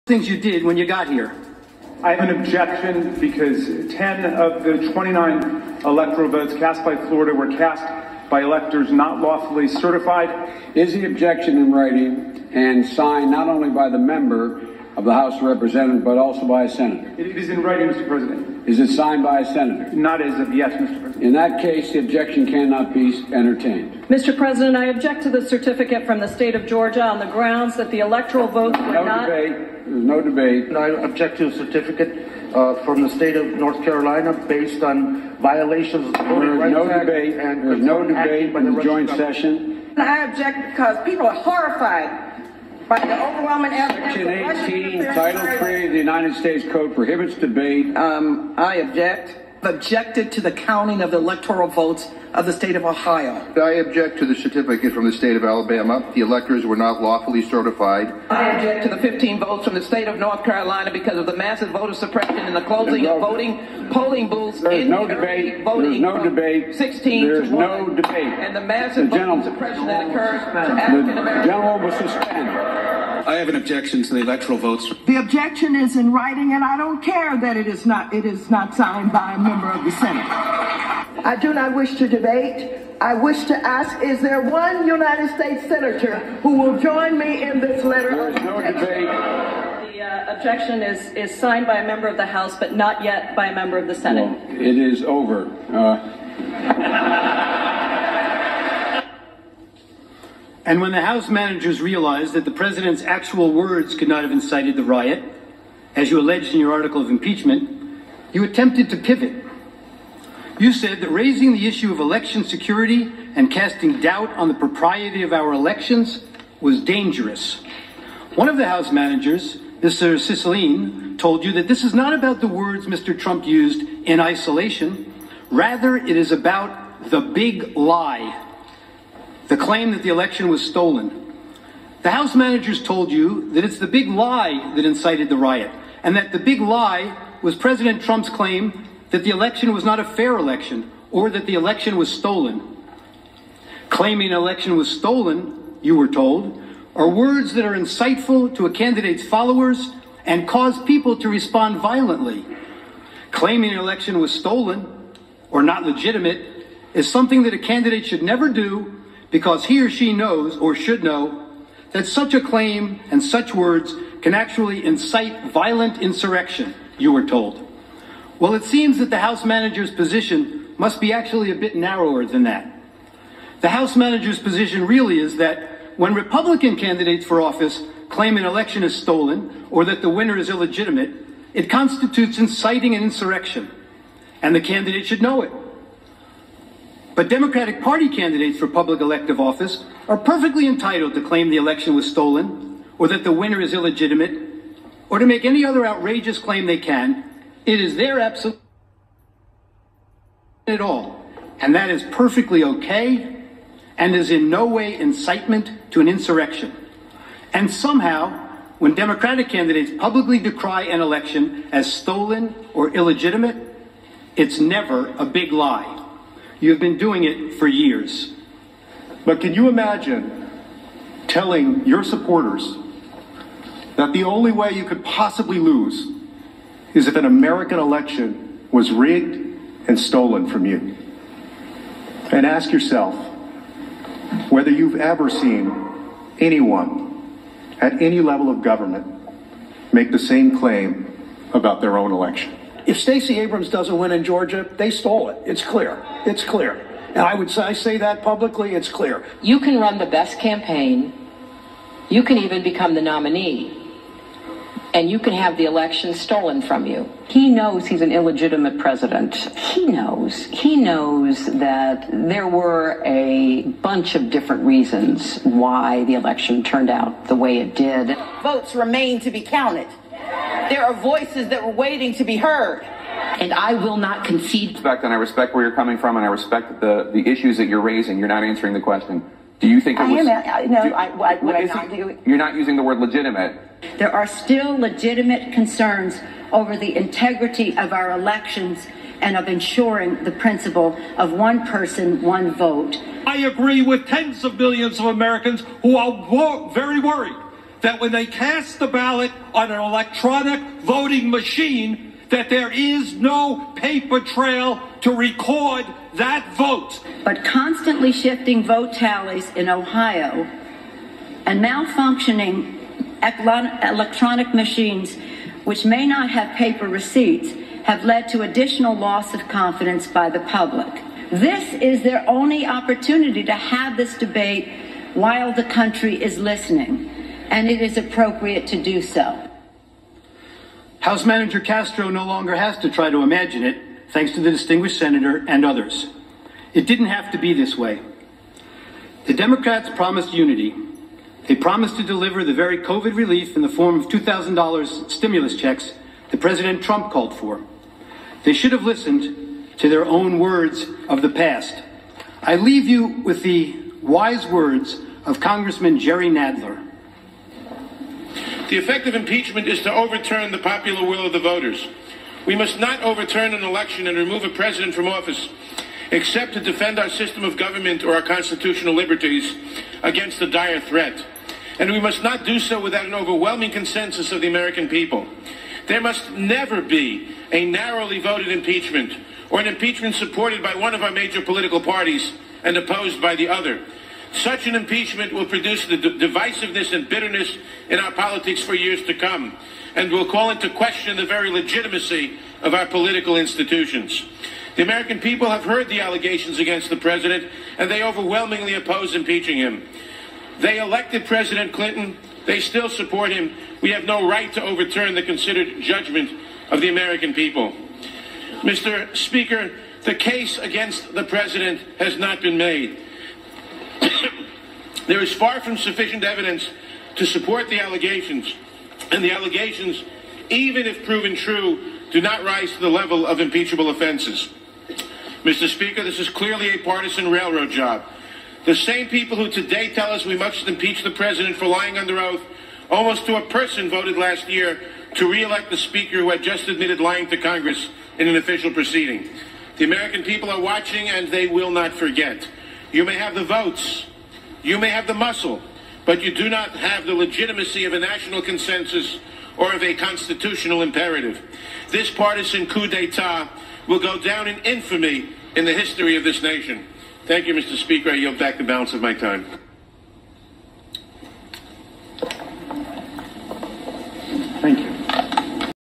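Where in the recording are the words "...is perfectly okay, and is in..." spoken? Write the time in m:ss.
3:21.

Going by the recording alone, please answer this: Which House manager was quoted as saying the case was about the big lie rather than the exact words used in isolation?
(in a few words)
Cicilline.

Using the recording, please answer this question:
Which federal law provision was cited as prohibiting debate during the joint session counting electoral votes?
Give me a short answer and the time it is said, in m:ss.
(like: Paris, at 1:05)
Section 18, Title 3, at 0:44.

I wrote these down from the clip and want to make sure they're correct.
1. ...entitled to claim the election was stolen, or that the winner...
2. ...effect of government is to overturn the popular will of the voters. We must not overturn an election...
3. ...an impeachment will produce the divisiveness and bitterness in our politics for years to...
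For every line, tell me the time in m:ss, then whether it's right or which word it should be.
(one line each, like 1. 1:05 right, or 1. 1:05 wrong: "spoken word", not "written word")
1. 3:10 right
2. 5:58 wrong: "impeachment", not "government"
3. 6:24 right.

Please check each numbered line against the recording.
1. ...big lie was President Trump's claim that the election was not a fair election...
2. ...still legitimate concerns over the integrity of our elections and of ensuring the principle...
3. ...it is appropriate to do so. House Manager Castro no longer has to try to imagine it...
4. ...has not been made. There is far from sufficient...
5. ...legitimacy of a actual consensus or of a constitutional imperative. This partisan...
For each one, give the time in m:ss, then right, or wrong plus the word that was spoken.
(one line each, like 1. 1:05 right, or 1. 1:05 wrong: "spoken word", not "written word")
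1. 2:16 right
2. 4:44 right
3. 5:27 right
4. 6:51 right
5. 7:27 wrong: "national", not "actual".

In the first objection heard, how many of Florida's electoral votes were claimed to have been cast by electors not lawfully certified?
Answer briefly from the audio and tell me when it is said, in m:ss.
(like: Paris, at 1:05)
10, at 0:03.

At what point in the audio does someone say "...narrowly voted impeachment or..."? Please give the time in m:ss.
6:17.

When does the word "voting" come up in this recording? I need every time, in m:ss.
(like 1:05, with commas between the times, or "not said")
0:36, 1:03, 5:00.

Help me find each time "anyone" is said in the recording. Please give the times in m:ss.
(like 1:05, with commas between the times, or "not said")
3:56.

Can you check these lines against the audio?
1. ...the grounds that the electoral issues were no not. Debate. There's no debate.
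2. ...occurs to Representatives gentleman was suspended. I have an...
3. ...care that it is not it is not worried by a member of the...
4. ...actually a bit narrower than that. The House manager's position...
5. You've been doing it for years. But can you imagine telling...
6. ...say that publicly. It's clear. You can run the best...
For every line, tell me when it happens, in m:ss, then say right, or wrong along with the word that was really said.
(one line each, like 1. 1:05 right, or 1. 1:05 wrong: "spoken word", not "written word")
1. 0:27 wrong: "votes", not "issues"
2. 1:10 wrong: "The", not "Representatives"
3. 1:17 wrong: "signed", not "worried"
4. 2:51 right
5. 3:36 right
6. 4:07 right.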